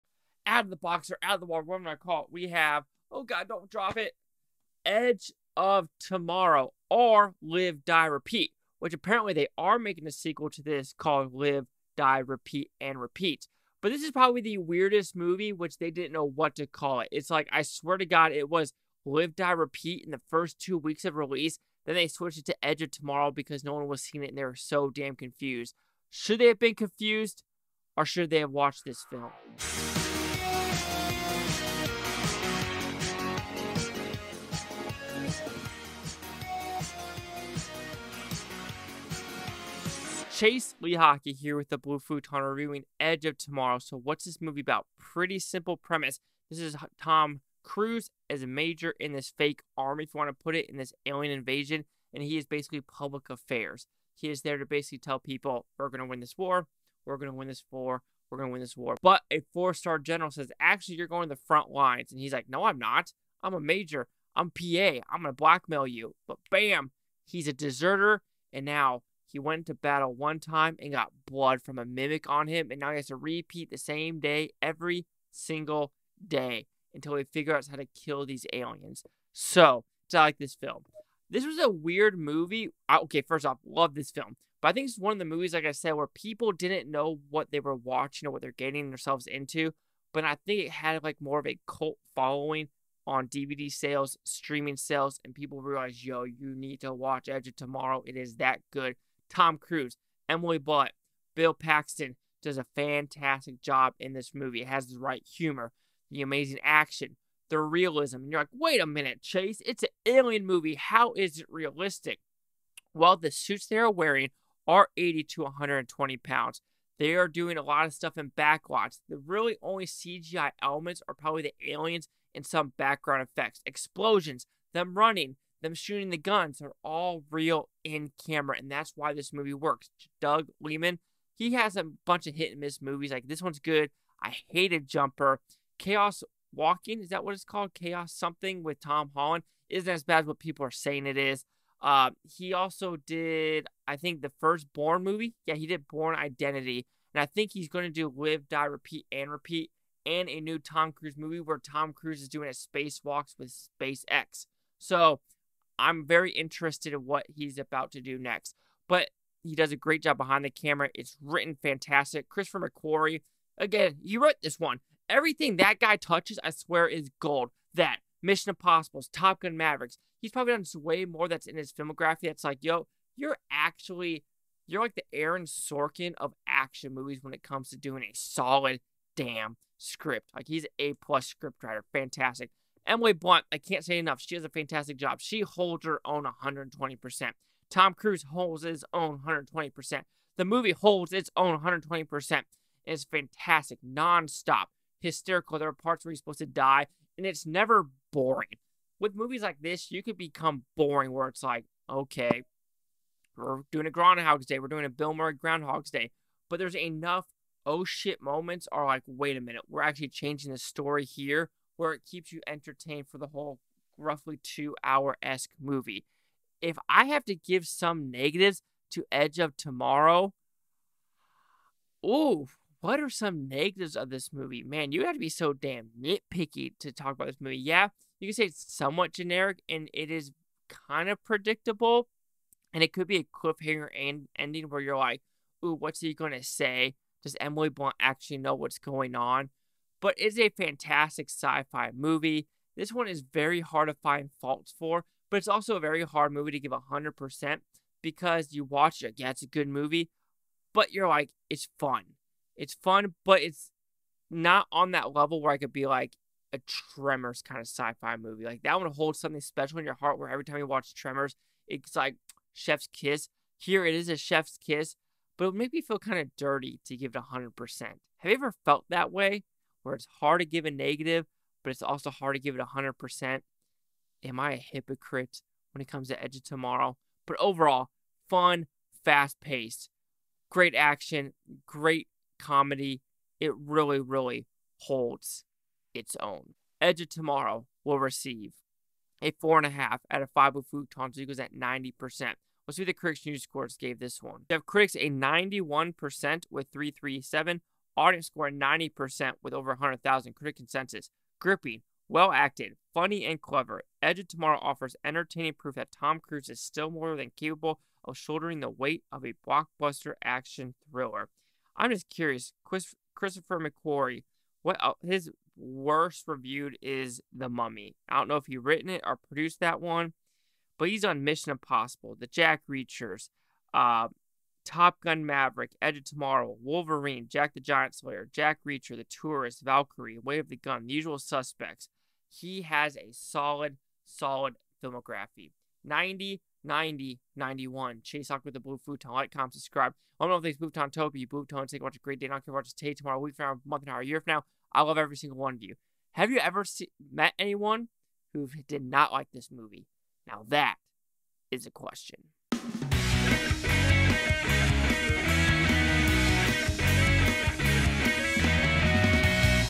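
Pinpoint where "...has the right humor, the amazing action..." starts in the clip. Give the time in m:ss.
1:44.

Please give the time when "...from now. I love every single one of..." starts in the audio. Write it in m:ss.
5:44.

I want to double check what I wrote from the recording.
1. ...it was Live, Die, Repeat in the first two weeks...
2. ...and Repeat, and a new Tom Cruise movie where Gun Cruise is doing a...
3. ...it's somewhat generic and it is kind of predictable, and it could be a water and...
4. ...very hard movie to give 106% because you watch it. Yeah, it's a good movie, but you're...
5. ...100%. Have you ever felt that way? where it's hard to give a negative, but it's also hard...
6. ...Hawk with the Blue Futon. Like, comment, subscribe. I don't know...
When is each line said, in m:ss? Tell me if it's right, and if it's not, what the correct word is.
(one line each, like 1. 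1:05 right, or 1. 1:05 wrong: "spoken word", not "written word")
1. 0:18 right
2. 2:29 wrong: "Tom", not "Gun"
3. 3:48 wrong: "cliffhanger", not "water"
4. 4:05 wrong: "100", not "106"
5. 4:27 right
6. 5:38 right.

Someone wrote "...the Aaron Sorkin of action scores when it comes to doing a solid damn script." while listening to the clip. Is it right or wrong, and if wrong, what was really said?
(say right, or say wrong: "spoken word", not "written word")
wrong: "movies", not "scores".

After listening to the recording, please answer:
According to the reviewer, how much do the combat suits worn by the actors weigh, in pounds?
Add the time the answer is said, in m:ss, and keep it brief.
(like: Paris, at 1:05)
80 to 120 pounds, at 1:54.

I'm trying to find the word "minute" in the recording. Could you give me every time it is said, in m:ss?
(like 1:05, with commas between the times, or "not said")
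1:48, 3:29.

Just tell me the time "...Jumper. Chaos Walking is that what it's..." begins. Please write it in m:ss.
2:14.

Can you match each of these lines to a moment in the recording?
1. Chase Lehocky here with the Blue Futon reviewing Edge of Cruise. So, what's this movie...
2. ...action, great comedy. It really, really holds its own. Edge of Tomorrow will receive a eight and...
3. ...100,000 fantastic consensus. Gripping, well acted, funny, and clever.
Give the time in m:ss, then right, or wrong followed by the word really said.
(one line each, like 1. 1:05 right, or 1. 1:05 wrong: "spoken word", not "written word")
1. 0:40 wrong: "Tomorrow", not "Cruise"
2. 4:40 wrong: "four", not "eight"
3. 4:59 wrong: "critic", not "fantastic".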